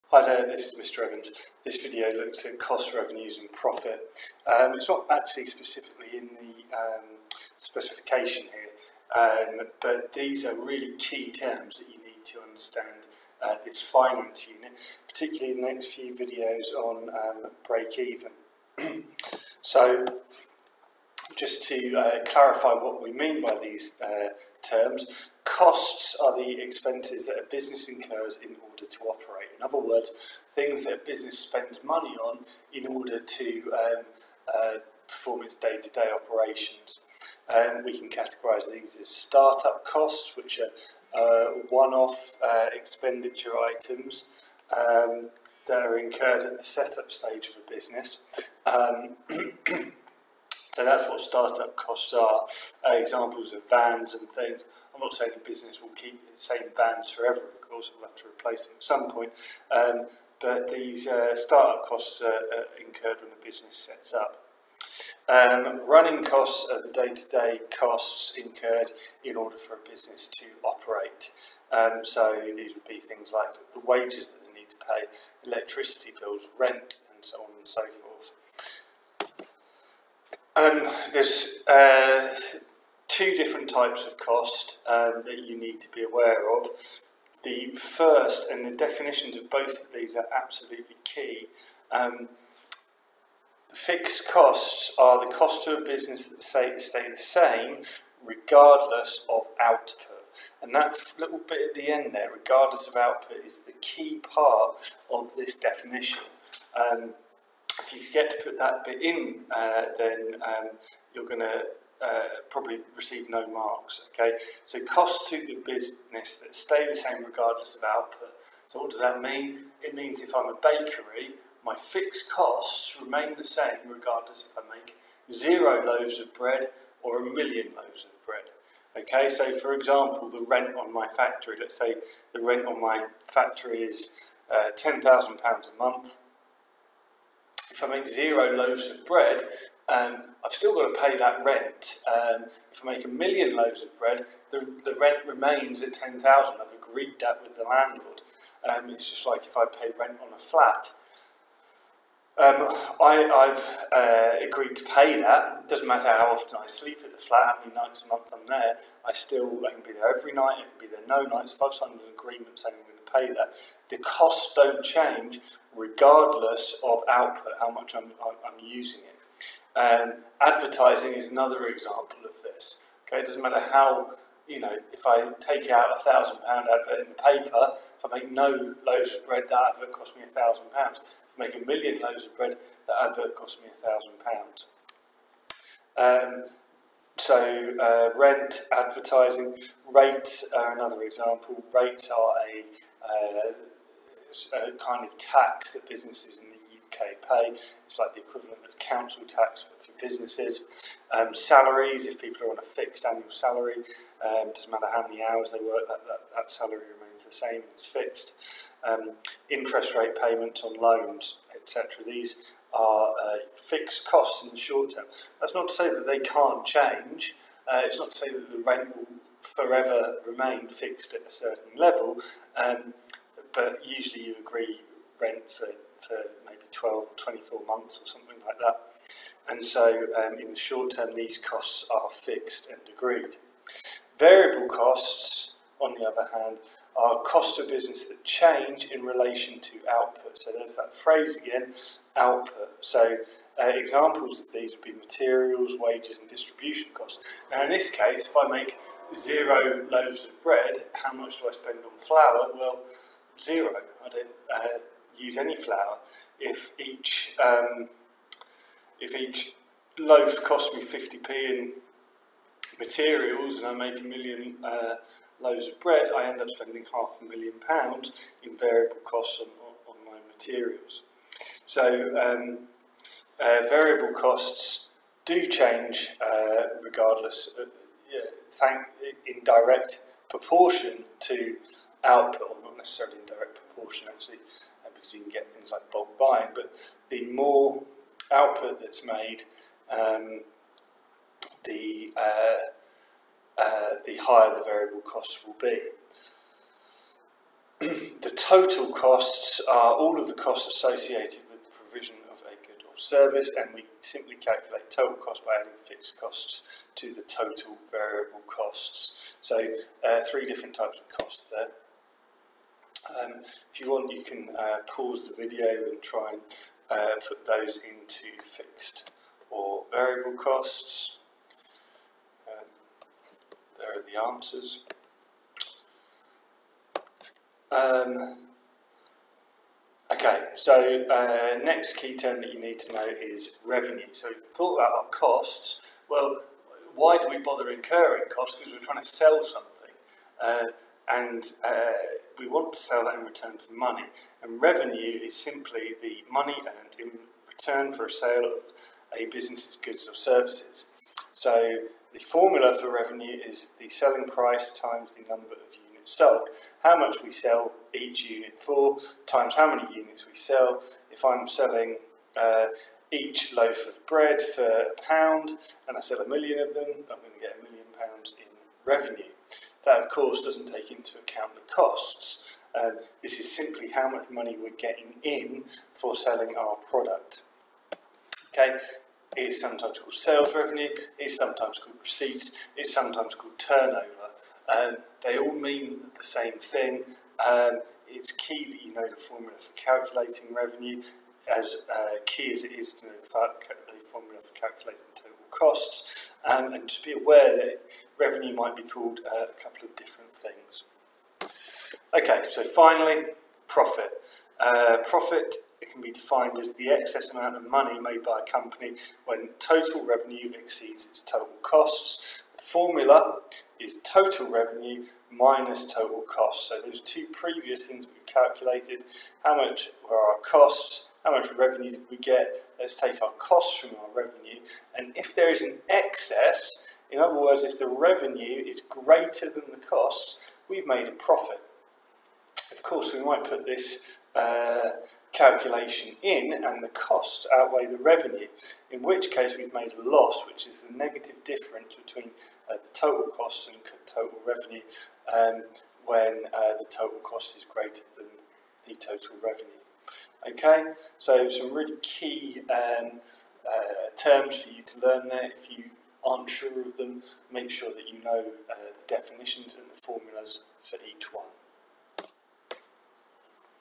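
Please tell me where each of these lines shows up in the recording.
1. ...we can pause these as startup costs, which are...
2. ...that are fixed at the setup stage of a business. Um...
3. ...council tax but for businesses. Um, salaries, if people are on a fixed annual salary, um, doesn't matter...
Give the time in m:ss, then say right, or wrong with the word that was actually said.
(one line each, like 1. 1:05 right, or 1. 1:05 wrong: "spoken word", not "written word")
1. 0:37 wrong: "categorise", not "pause"
2. 0:45 wrong: "incurred", not "fixed"
3. 3:18 right.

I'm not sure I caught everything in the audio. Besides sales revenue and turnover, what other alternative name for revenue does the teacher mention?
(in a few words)
Receipts.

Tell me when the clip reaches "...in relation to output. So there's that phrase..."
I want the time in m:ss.
3:58.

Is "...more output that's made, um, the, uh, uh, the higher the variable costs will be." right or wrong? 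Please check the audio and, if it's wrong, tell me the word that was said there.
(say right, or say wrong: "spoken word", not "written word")
right.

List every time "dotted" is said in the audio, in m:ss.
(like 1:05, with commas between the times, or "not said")
not said.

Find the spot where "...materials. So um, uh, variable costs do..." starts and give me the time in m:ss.
4:30.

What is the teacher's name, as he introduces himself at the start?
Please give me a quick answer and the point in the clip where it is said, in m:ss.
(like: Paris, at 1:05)
Mr. Evans, at 0:00.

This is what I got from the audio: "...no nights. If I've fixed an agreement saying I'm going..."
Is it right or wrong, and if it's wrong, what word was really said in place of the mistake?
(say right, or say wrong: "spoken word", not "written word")
wrong: "signed", not "fixed".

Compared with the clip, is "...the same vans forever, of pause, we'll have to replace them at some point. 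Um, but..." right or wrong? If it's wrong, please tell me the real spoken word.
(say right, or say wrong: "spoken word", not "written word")
wrong: "course", not "pause".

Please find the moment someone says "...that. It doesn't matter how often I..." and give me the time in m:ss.
2:35.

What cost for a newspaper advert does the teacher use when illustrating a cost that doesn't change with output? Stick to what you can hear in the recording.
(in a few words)
£1,000.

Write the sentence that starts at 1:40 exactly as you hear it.
And that little bit at the end there, regardless of output, is the key part of this definition.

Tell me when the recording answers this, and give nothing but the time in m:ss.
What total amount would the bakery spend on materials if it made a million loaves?
4:26.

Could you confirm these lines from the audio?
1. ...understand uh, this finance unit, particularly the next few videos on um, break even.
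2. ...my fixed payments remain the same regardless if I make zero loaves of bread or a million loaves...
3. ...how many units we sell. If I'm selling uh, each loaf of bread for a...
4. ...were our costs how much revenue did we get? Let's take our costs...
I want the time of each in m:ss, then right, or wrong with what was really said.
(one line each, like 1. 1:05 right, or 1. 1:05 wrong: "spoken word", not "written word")
1. 0:12 right
2. 2:01 wrong: "costs", not "payments"
3. 5:59 right
4. 7:00 right.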